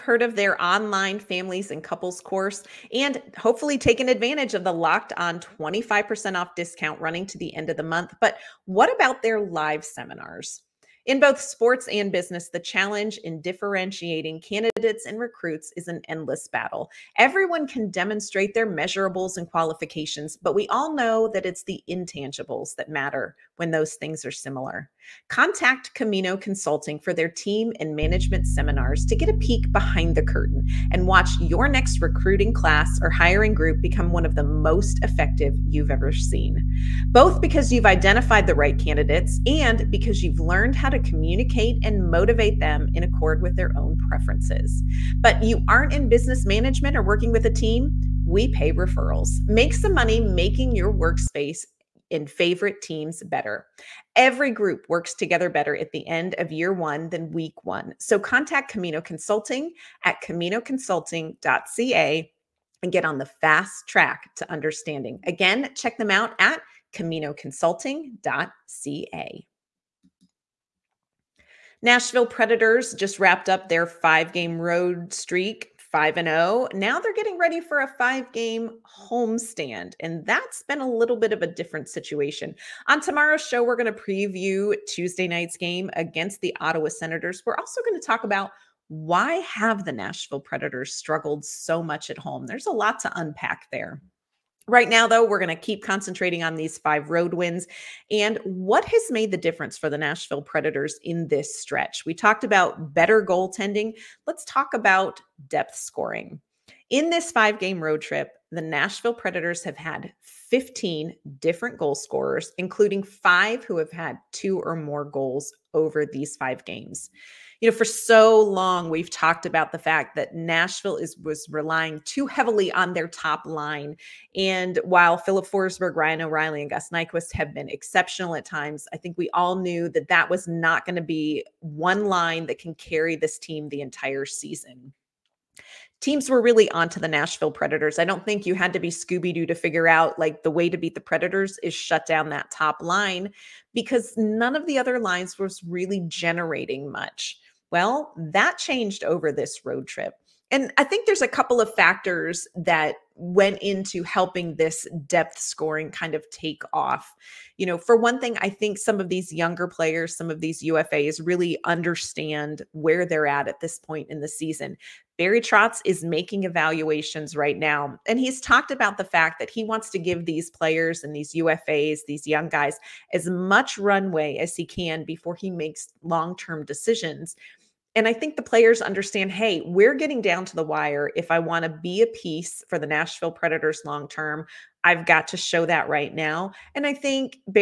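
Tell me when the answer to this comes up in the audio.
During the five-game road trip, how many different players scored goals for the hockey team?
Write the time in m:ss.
1:50.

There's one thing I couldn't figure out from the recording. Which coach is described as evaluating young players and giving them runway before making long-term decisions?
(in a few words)
Barry Trotz.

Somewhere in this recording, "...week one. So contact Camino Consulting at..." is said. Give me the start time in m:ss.
0:57.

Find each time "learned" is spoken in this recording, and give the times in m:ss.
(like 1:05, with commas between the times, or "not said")
0:40.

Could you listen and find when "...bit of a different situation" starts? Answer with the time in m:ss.
1:21.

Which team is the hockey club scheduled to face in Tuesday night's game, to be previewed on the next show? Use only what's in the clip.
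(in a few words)
Ottawa Senators.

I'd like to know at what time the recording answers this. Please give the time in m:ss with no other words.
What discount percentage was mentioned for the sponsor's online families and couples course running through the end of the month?
0:05.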